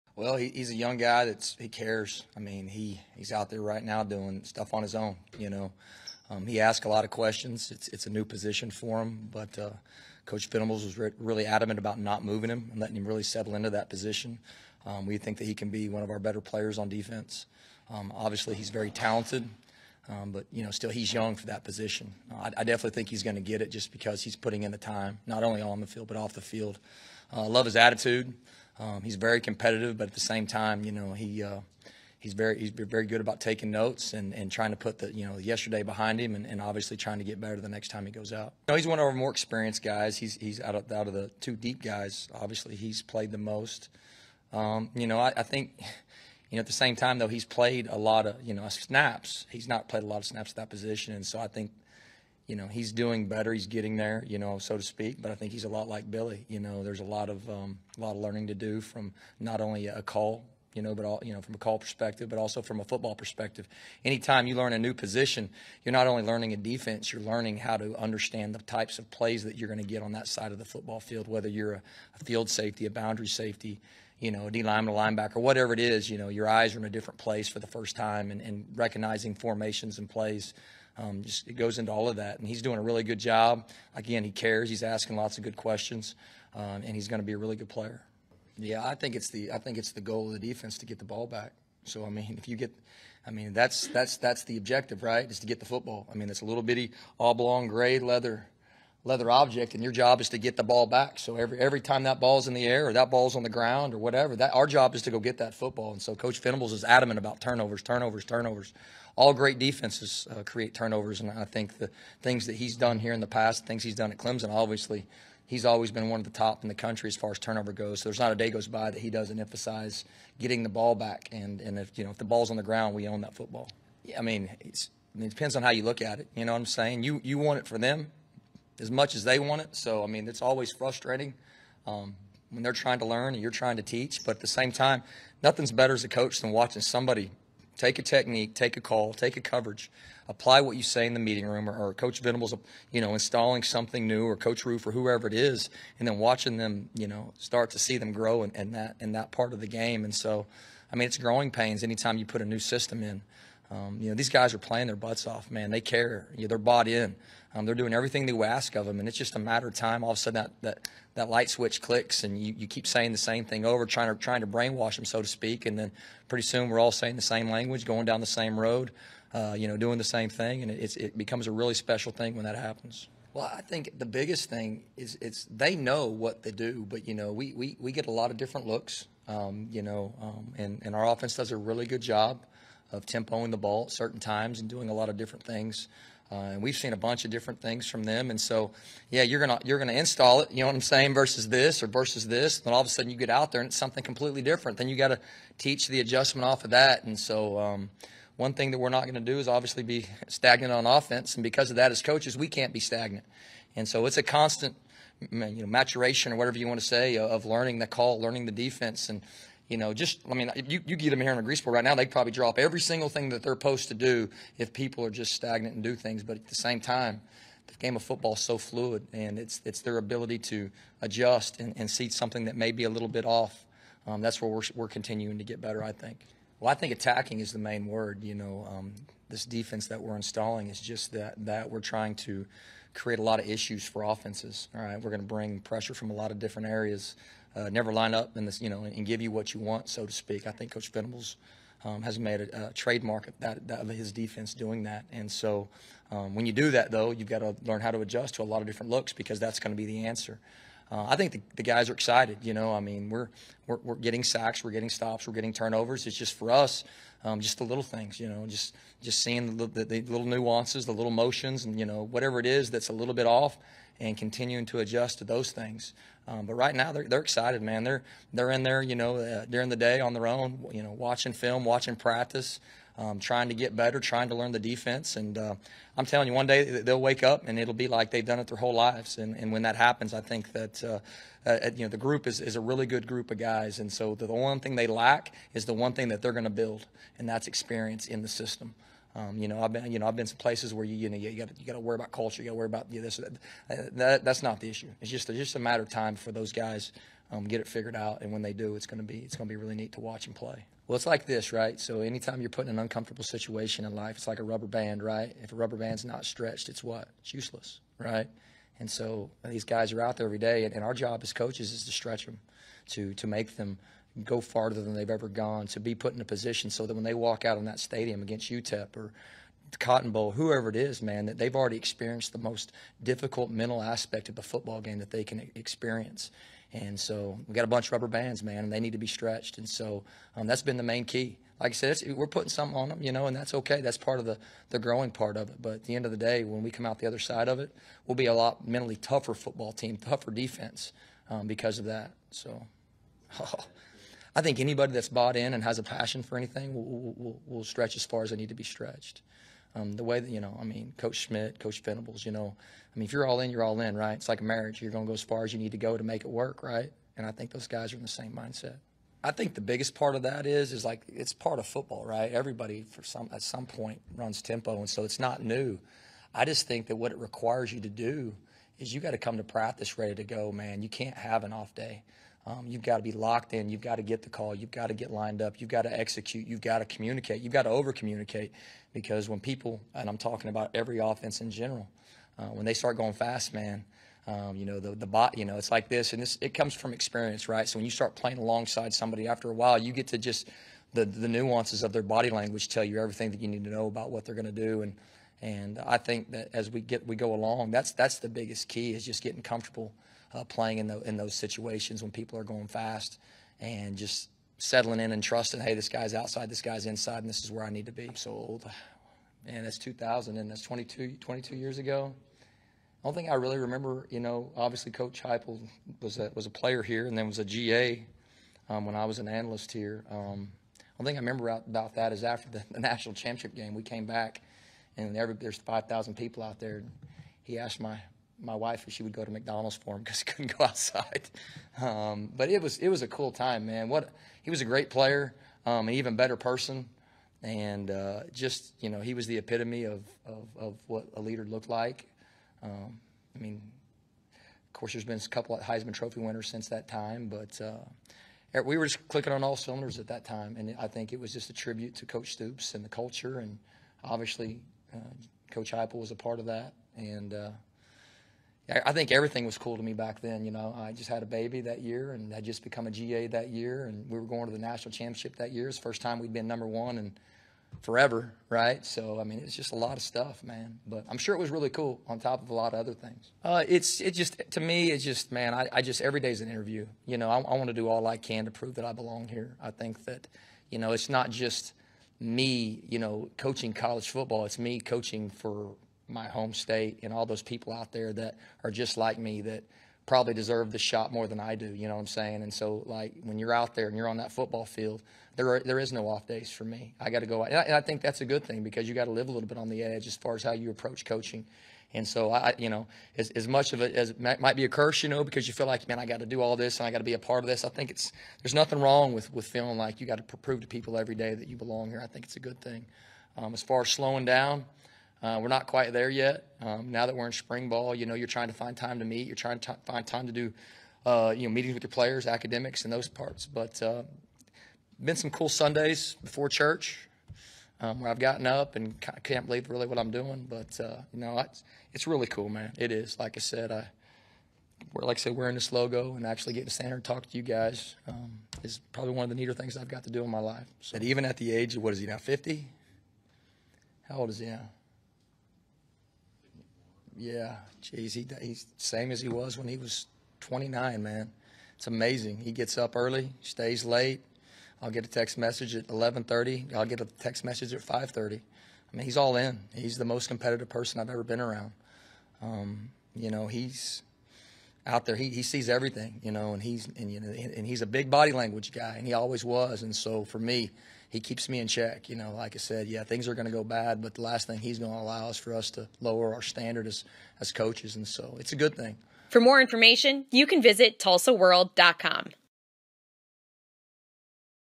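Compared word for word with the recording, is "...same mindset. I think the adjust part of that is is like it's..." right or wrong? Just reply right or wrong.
wrong.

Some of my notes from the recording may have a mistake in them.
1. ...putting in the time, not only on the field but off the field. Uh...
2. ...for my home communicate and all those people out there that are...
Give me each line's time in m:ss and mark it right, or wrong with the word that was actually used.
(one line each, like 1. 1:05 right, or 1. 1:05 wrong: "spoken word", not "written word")
1. 0:24 right
2. 8:05 wrong: "state", not "communicate".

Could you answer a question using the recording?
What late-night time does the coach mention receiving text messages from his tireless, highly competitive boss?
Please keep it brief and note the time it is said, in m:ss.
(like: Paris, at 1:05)
11:30, at 9:15.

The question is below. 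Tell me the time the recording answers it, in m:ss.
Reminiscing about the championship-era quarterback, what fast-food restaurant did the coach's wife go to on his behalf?
7:09.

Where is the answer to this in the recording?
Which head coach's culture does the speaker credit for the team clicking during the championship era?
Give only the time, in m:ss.
7:32.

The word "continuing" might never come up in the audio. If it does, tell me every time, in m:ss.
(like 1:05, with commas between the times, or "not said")
3:44, 4:24.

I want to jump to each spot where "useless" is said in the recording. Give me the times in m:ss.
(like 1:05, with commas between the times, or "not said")
5:07.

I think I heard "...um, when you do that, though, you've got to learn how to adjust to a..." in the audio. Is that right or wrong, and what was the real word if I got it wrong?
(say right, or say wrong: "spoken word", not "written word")
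right.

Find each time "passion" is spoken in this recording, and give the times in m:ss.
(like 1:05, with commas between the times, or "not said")
5:45.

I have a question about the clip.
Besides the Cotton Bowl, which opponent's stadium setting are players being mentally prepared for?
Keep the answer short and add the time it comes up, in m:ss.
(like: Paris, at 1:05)
UTEP, at 5:18.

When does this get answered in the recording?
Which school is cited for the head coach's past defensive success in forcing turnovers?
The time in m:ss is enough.
1:54.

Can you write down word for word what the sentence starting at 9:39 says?
For more information, you can visit TulsaWorld.com.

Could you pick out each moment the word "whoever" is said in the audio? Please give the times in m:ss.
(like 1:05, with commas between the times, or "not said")
2:24, 5:20.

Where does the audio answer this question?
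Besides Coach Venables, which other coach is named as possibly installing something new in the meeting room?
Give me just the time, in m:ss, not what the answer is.
2:24.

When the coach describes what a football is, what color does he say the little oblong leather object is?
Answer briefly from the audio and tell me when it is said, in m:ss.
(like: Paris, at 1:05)
gray, at 1:37.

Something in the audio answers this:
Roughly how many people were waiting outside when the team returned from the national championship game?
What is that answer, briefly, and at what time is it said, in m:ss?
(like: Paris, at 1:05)
5,000, at 7:05.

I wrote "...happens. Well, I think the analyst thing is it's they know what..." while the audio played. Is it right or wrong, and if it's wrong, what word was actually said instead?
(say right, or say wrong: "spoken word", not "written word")
wrong: "biggest", not "analyst".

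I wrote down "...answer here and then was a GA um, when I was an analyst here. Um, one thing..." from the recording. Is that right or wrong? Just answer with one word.
wrong.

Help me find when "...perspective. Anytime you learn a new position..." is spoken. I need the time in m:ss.
1:03.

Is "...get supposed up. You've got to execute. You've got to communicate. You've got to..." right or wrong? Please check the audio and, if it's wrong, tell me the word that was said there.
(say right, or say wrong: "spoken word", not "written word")
wrong: "lined", not "supposed".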